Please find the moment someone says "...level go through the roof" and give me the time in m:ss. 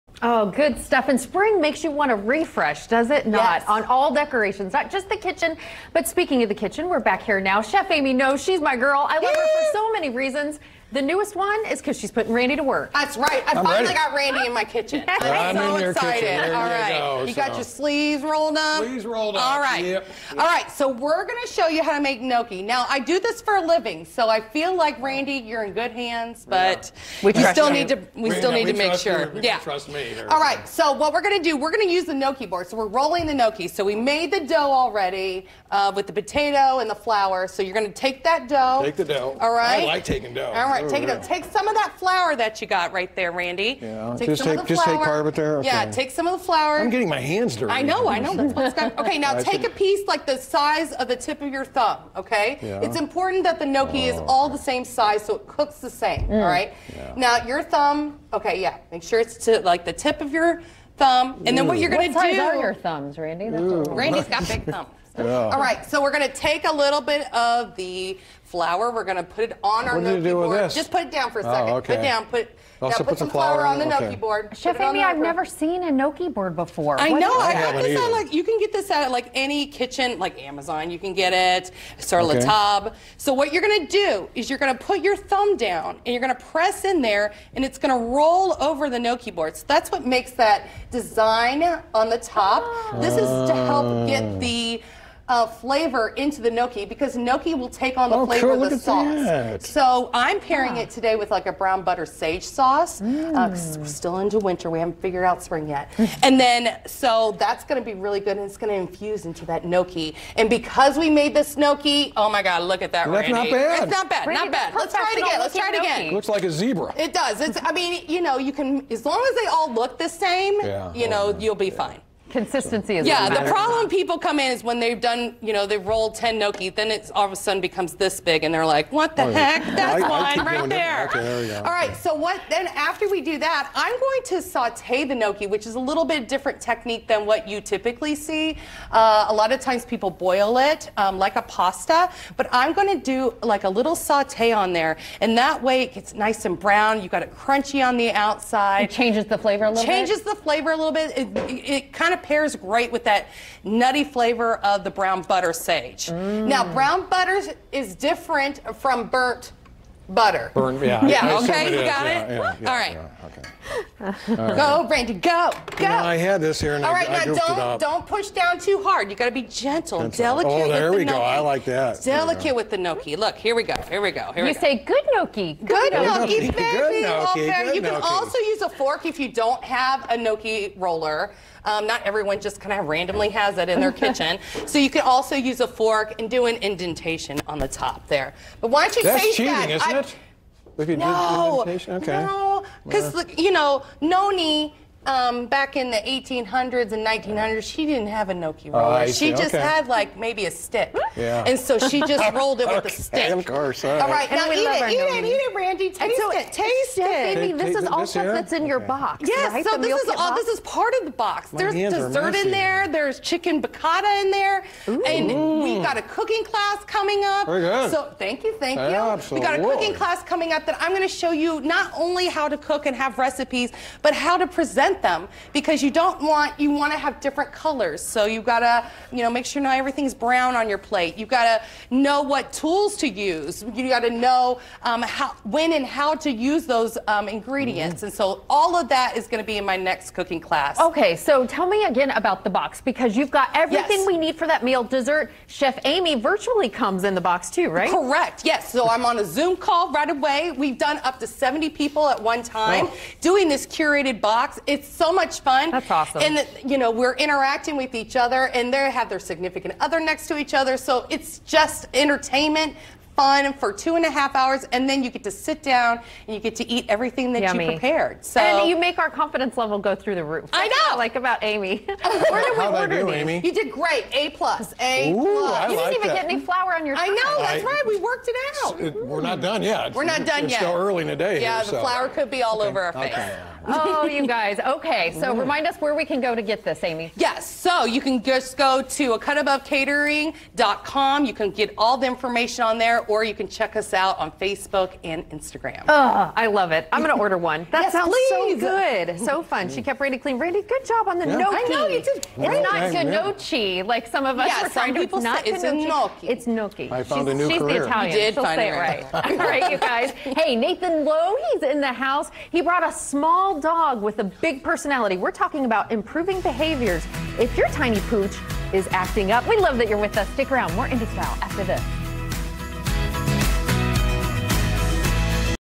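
4:29.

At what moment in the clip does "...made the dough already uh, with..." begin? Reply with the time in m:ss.
0:33.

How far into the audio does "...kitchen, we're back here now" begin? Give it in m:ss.
0:06.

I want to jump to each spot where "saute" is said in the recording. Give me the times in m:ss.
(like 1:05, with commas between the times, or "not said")
2:14, 2:23.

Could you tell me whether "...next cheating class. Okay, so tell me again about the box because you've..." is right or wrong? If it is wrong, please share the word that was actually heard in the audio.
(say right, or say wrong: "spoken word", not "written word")
wrong: "cooking", not "cheating".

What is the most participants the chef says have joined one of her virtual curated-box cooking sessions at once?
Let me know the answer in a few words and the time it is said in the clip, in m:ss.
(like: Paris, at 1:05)
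70, at 4:11.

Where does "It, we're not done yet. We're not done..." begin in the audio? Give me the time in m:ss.
4:38.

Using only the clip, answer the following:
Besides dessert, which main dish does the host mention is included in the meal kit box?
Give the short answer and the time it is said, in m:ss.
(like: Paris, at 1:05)
chicken piccata, at 3:33.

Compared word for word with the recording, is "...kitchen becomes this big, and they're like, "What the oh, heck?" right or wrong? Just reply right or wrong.
wrong.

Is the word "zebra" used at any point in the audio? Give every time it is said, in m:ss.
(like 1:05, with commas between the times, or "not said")
1:56.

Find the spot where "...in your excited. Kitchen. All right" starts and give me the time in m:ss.
0:15.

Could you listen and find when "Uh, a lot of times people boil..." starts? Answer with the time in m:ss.
2:18.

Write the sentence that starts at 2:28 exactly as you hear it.
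It changes the flavor a little.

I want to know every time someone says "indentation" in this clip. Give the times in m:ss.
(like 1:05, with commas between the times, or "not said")
3:06, 3:11.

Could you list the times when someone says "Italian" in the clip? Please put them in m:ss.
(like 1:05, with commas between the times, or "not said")
5:07.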